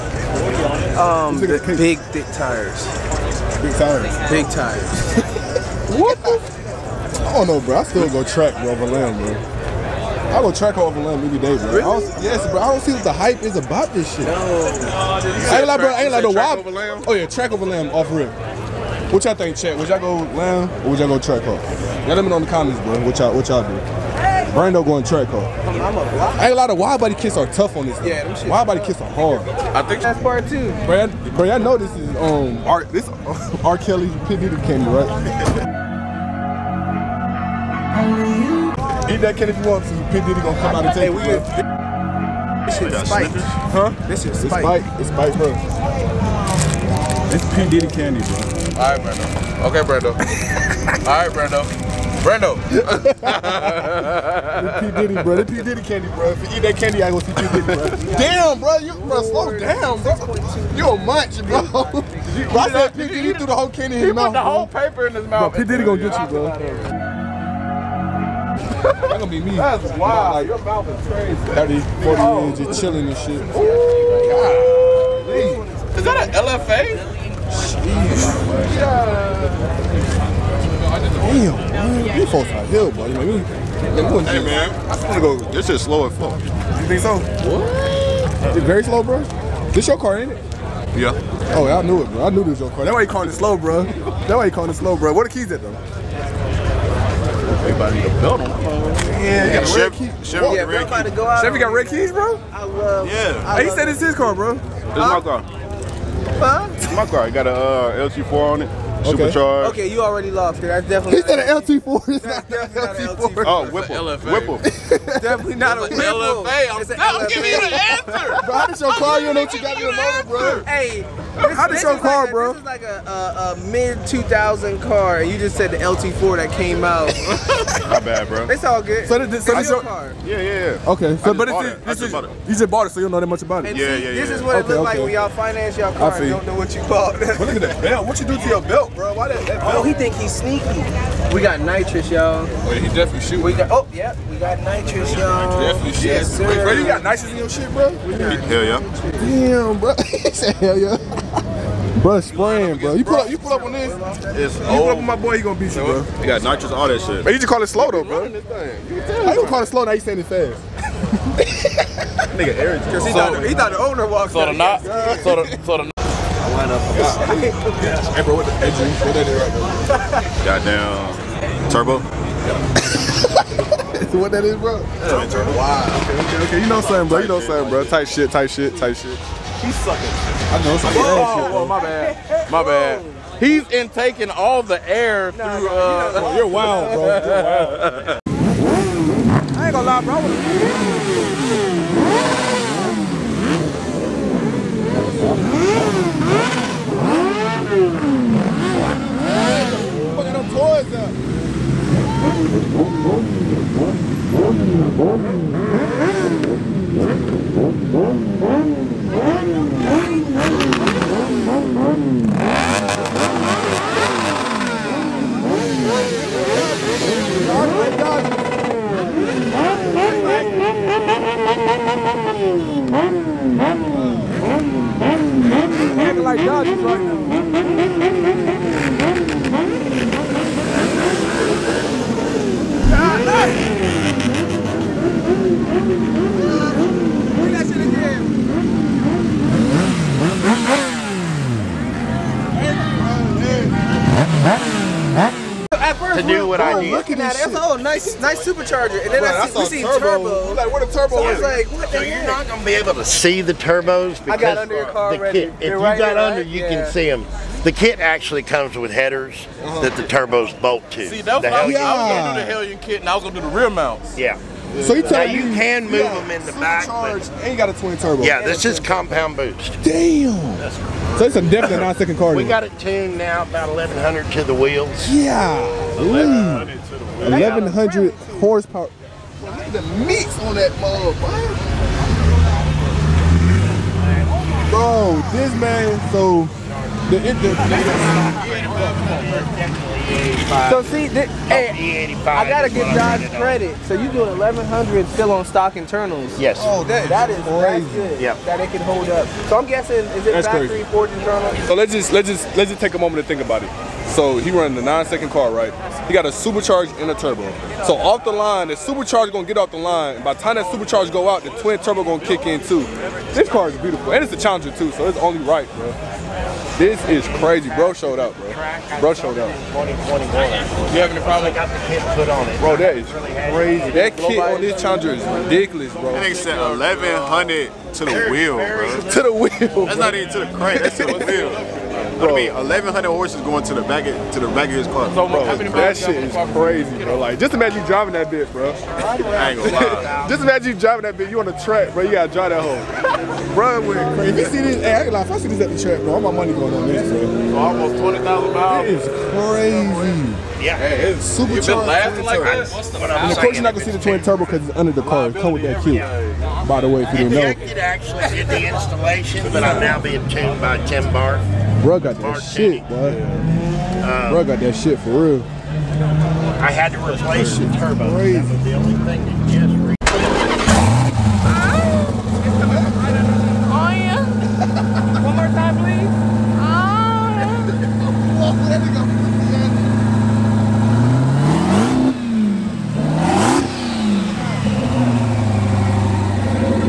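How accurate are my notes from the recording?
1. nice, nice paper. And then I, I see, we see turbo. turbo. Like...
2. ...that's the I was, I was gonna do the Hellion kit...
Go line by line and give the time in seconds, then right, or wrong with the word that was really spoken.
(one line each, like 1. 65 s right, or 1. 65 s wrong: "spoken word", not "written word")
1. 247 s wrong: "supercharger", not "paper"
2. 261 s right.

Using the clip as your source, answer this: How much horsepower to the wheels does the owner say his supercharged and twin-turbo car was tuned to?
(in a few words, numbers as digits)
1100.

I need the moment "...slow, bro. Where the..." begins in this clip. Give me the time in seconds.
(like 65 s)
94 s.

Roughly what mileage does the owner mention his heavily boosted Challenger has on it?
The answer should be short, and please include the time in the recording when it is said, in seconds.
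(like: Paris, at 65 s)
20,000 miles, at 347 s.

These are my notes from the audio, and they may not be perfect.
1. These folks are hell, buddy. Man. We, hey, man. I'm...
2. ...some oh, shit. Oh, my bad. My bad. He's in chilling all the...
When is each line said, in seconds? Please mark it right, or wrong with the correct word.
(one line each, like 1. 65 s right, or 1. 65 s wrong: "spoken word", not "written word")
1. 82 s right
2. 180 s wrong: "taking", not "chilling".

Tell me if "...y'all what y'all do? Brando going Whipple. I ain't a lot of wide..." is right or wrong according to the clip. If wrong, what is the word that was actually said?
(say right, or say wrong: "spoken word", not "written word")
wrong: "Trackhawk", not "Whipple".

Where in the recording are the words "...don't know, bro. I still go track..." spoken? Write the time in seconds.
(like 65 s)
7 s.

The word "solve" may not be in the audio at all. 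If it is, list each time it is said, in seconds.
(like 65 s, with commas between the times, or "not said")
not said.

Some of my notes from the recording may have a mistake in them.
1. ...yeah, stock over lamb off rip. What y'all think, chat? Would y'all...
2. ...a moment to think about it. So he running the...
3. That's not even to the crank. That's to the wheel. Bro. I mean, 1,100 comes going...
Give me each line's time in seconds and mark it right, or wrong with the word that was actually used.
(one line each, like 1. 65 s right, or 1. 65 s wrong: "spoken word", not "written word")
1. 17 s wrong: "track", not "stock"
2. 302 s right
3. 329 s wrong: "horses", not "comes".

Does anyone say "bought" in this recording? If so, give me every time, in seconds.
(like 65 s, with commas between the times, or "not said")
132 s, 136 s.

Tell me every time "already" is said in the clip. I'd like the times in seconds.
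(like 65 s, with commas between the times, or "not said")
110 s, 255 s.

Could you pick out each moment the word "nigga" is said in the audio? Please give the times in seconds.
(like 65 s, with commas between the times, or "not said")
162 s, 326 s.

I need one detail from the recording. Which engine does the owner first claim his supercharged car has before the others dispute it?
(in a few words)
LT4.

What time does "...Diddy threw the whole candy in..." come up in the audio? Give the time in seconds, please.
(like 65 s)
63 s.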